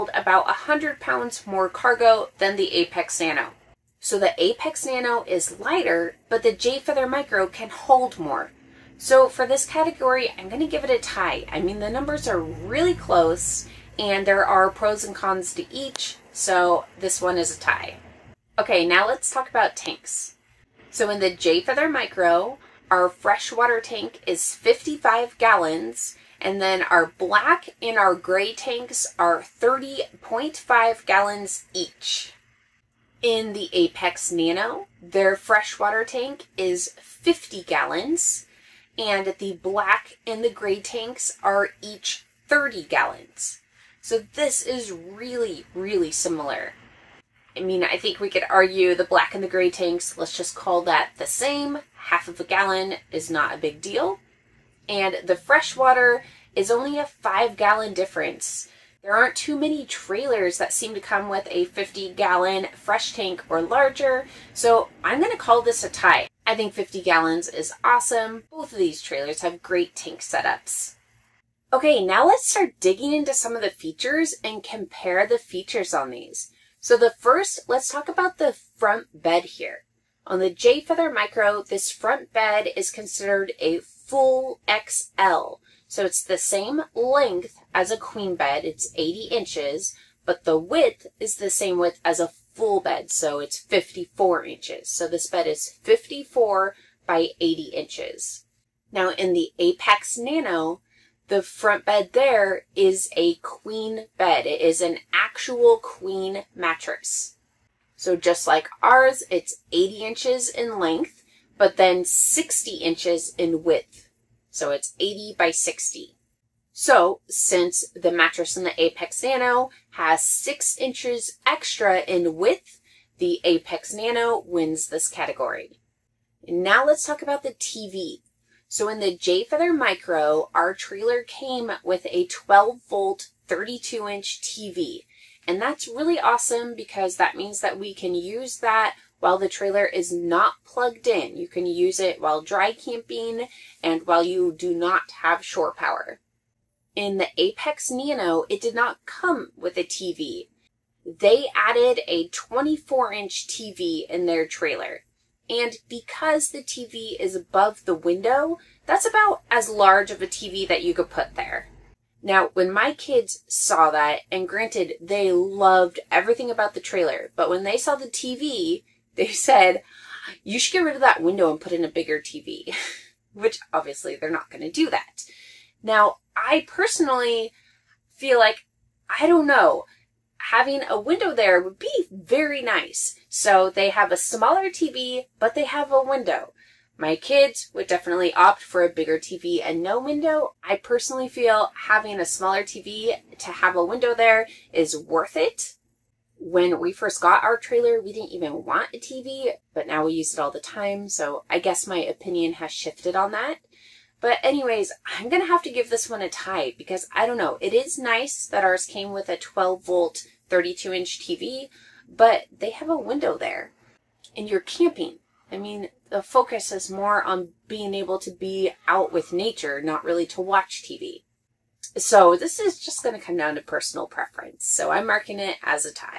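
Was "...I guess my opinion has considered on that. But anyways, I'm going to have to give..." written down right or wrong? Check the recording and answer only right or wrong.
wrong.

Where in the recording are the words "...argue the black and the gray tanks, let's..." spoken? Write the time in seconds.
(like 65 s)
48 s.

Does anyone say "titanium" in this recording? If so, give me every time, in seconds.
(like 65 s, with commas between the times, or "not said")
not said.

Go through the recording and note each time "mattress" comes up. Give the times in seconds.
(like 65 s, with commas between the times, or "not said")
106 s, 118 s.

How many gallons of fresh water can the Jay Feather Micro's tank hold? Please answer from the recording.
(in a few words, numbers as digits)
55 gallons.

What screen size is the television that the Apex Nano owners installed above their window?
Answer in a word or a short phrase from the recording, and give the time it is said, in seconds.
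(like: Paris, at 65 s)
24 inch, at 152 s.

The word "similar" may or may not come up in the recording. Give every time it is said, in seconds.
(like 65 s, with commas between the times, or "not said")
46 s.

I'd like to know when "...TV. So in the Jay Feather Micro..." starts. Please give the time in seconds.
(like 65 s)
127 s.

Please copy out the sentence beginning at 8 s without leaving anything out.
So for this category, I'm going to give it a tie.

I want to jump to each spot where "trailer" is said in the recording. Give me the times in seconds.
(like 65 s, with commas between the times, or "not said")
59 s, 69 s, 130 s, 139 s, 154 s, 166 s, 197 s.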